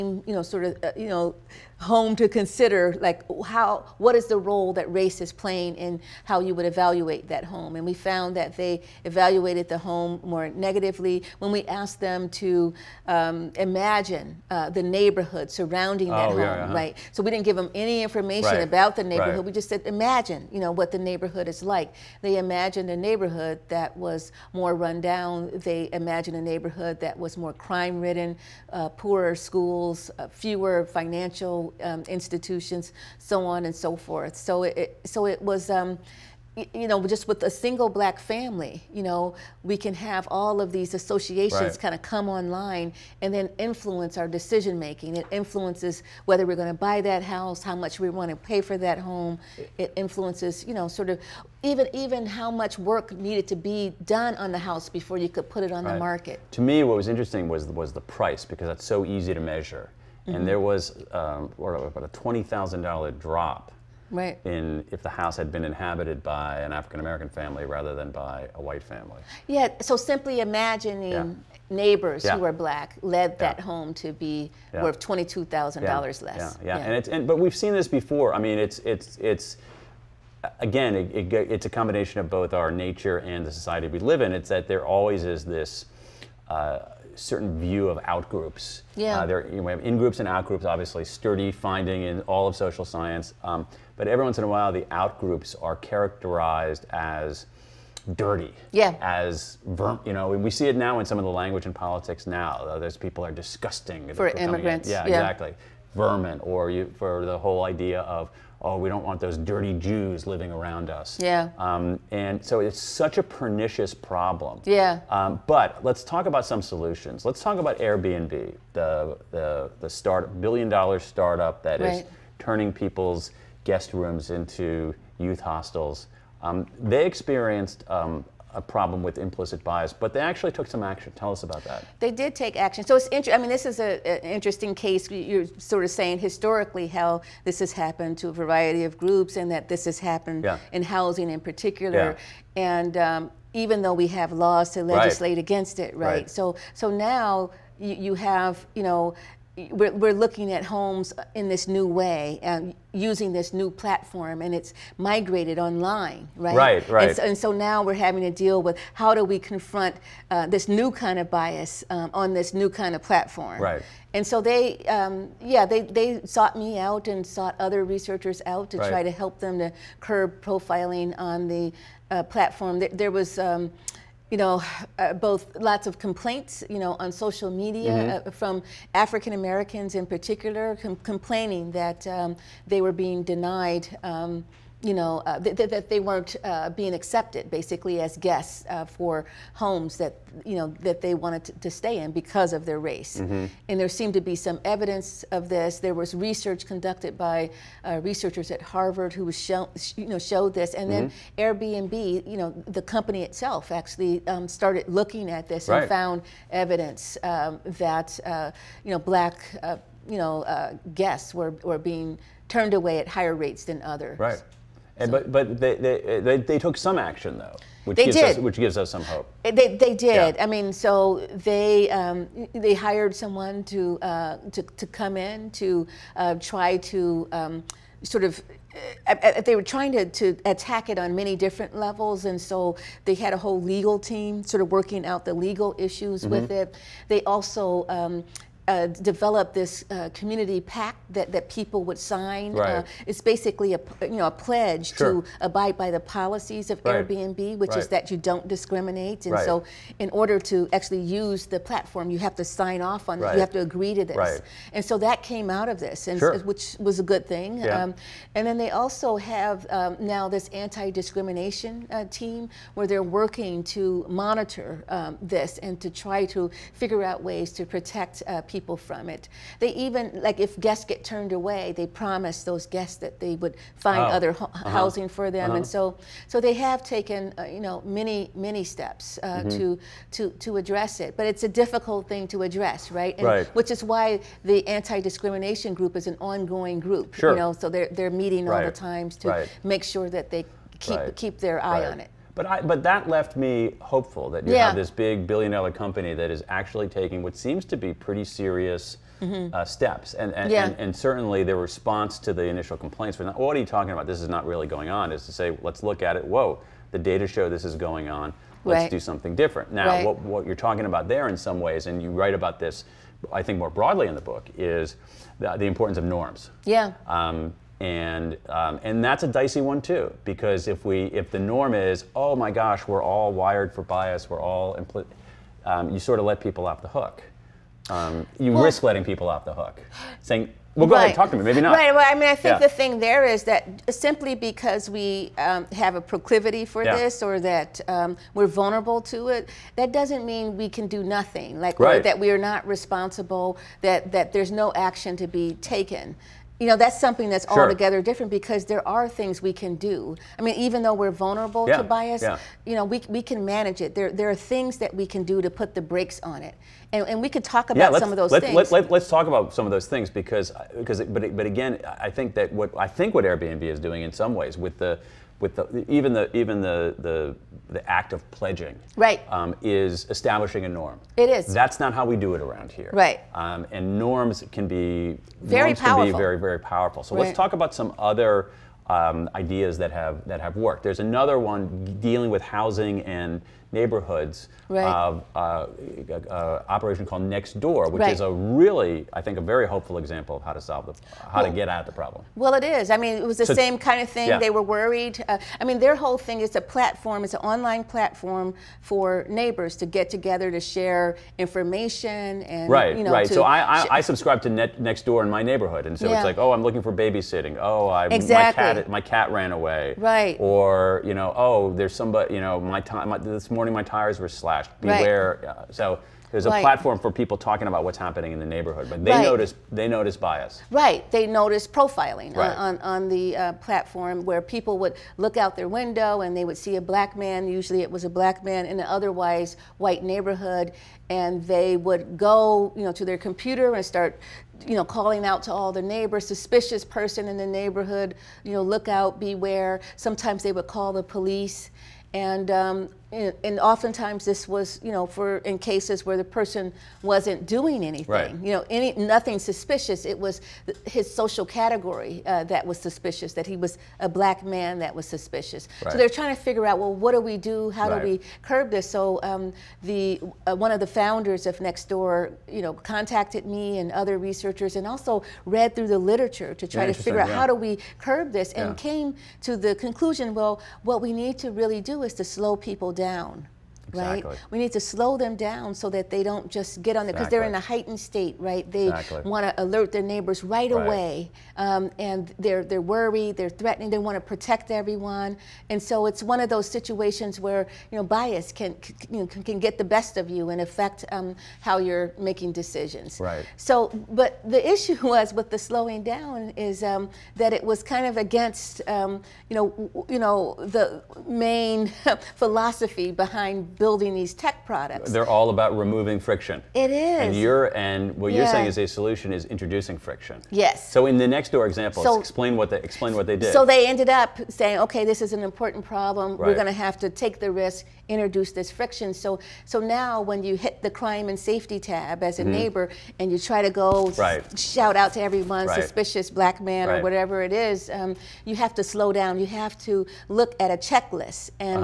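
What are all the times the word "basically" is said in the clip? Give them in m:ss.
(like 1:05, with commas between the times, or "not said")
3:07, 4:03.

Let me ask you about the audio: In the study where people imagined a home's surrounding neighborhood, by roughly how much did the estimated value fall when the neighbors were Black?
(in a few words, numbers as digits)
$22,000.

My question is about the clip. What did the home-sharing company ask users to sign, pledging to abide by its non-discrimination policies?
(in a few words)
community pact.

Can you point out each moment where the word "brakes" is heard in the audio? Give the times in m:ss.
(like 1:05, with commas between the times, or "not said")
5:55.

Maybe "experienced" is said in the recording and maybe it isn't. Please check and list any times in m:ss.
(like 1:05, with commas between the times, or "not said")
2:07.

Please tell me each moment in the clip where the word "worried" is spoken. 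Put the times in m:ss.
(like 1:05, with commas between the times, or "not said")
6:34, 8:02.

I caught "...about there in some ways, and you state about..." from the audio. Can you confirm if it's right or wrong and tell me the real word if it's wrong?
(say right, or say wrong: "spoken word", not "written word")
wrong: "write", not "state".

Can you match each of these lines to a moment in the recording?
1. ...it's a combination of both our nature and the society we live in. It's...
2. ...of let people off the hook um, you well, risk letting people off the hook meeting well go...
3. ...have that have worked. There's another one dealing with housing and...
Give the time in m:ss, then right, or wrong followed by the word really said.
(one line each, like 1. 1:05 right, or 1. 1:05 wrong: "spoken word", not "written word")
1. 1:21 right
2. 5:26 wrong: "saying", not "meeting"
3. 6:19 right.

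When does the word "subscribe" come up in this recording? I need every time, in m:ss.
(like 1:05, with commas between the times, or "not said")
6:44.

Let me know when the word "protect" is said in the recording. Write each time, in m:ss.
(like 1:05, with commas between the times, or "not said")
4:27, 8:04.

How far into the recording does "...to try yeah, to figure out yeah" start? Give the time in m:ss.
7:46.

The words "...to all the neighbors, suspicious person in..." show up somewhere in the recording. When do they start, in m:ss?
7:15.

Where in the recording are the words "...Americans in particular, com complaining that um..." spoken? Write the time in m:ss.
2:59.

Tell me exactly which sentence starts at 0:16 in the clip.
right so we didn't give them any information right.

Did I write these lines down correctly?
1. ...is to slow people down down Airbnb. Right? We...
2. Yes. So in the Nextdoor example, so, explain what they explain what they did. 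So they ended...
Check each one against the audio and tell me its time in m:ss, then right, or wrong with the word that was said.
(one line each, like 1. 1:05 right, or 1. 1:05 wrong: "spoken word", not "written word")
1. 7:52 wrong: "Exactly", not "Airbnb"
2. 8:30 right.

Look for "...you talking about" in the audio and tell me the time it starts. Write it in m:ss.
5:03.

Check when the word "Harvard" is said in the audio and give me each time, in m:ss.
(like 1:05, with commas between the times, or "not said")
3:18.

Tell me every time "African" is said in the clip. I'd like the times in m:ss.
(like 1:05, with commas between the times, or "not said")
1:06, 2:58.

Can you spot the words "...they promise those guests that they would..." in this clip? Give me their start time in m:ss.
4:31.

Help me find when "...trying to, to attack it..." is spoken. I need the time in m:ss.
3:49.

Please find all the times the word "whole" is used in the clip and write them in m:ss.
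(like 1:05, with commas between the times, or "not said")
1:47, 3:53, 6:35.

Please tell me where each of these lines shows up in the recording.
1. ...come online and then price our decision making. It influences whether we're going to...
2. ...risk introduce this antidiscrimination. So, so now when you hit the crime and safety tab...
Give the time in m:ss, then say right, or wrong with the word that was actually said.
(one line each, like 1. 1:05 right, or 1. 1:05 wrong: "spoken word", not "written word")
1. 0:42 wrong: "influence", not "price"
2. 8:37 wrong: "friction", not "antidiscrimination".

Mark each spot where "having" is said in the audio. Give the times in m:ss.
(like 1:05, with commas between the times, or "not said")
2:37.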